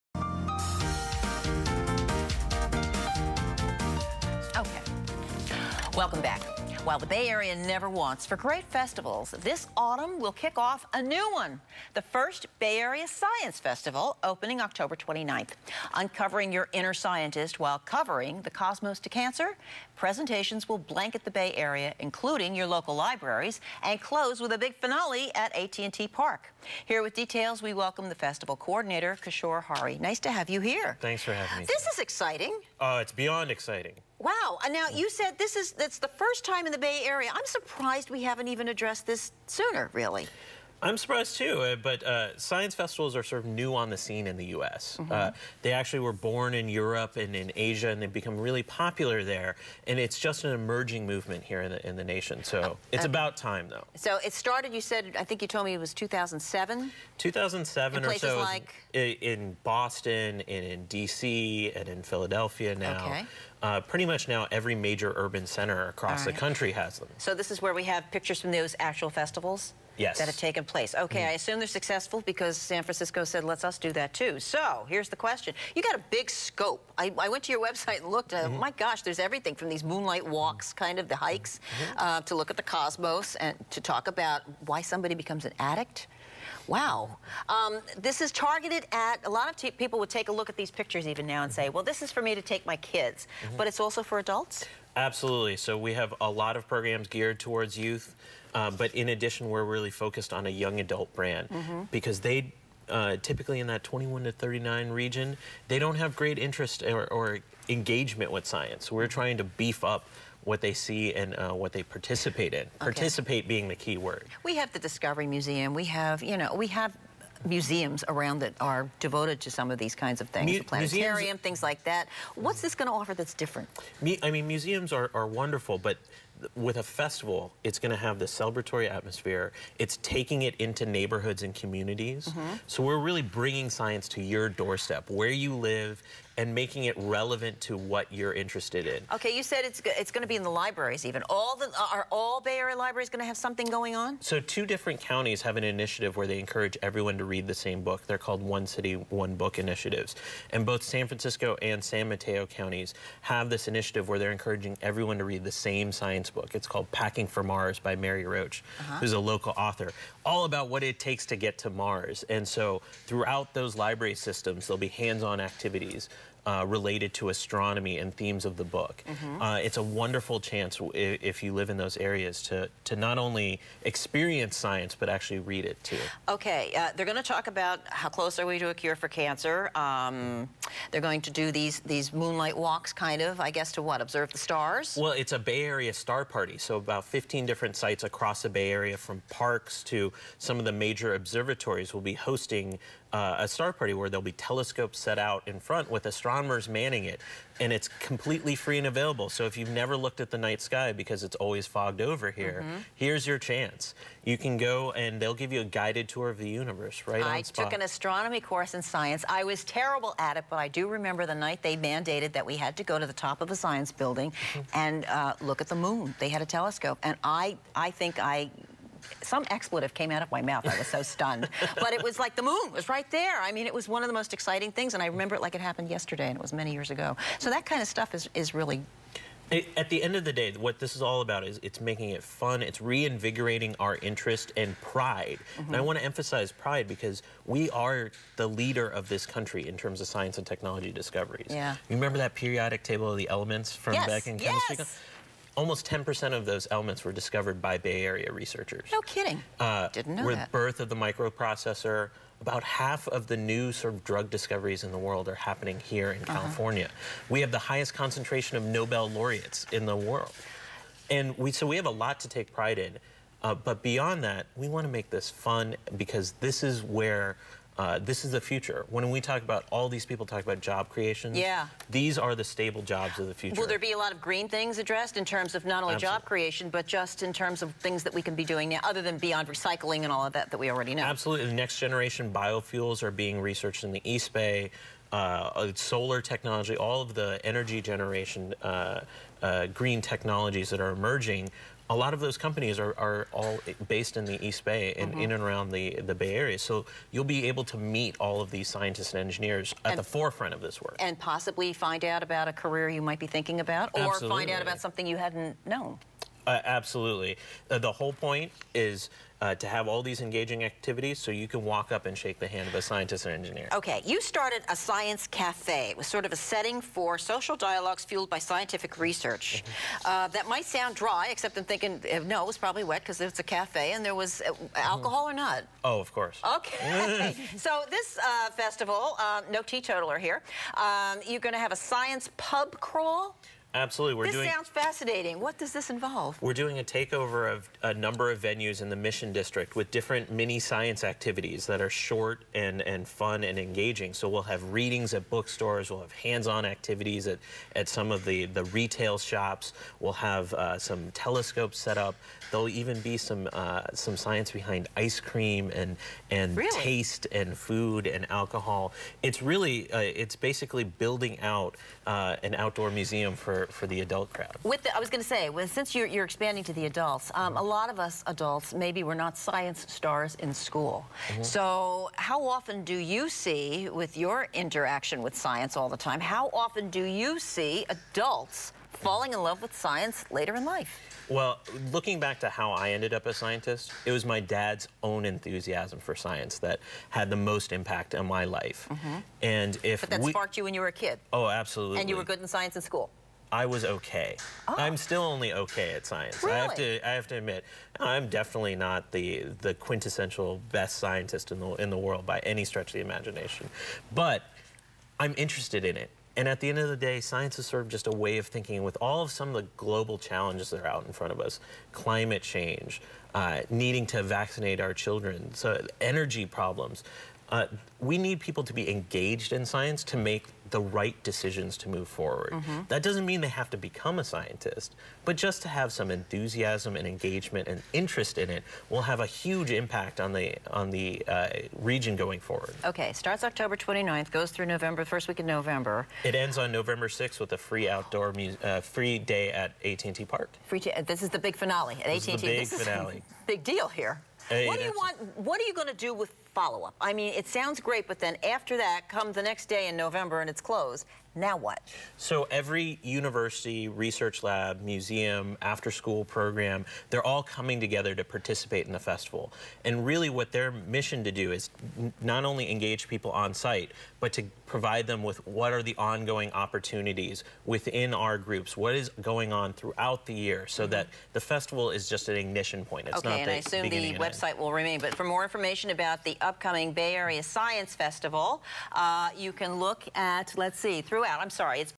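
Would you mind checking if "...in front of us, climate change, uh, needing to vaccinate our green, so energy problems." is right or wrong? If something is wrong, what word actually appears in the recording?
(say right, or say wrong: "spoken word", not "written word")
wrong: "children", not "green".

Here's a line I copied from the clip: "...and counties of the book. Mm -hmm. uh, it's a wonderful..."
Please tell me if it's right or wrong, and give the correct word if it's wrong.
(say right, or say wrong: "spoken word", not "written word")
wrong: "themes", not "counties".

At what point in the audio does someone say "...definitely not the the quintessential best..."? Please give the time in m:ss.
6:38.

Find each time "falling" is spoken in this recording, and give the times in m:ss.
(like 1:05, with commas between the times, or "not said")
6:19.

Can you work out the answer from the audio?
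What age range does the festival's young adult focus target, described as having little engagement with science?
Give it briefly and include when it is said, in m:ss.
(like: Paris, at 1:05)
21 to 39, at 1:43.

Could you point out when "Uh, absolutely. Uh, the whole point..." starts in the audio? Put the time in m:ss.
5:06.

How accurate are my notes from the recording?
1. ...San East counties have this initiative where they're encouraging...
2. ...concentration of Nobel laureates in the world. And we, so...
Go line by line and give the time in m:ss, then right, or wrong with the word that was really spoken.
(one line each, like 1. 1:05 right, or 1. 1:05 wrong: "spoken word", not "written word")
1. 2:31 wrong: "Mateo", not "East"
2. 4:17 right.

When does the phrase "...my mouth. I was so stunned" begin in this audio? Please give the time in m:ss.
3:40.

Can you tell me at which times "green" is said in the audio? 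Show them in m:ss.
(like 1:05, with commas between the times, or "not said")
4:34, 4:49.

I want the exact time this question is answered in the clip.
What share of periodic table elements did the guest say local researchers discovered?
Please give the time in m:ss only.
4:05.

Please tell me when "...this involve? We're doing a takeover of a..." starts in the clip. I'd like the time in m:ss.
5:35.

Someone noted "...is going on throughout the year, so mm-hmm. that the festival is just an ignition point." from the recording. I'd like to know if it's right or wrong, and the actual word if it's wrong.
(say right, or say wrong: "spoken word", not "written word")
right.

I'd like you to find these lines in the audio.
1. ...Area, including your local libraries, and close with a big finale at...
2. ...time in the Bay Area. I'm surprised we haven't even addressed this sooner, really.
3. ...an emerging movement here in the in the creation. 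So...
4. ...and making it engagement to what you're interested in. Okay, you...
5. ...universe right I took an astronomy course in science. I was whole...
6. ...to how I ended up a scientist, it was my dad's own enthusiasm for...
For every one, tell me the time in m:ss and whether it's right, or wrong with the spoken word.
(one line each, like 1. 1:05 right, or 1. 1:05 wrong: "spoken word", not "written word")
1. 0:21 right
2. 0:36 right
3. 0:50 wrong: "nation", not "creation"
4. 2:16 wrong: "relevant", not "engagement"
5. 3:26 wrong: "terrible", not "whole"
6. 6:22 right.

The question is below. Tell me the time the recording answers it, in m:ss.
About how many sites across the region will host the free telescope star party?
3:07.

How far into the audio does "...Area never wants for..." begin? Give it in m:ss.
0:07.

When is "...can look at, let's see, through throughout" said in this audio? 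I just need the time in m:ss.
7:59.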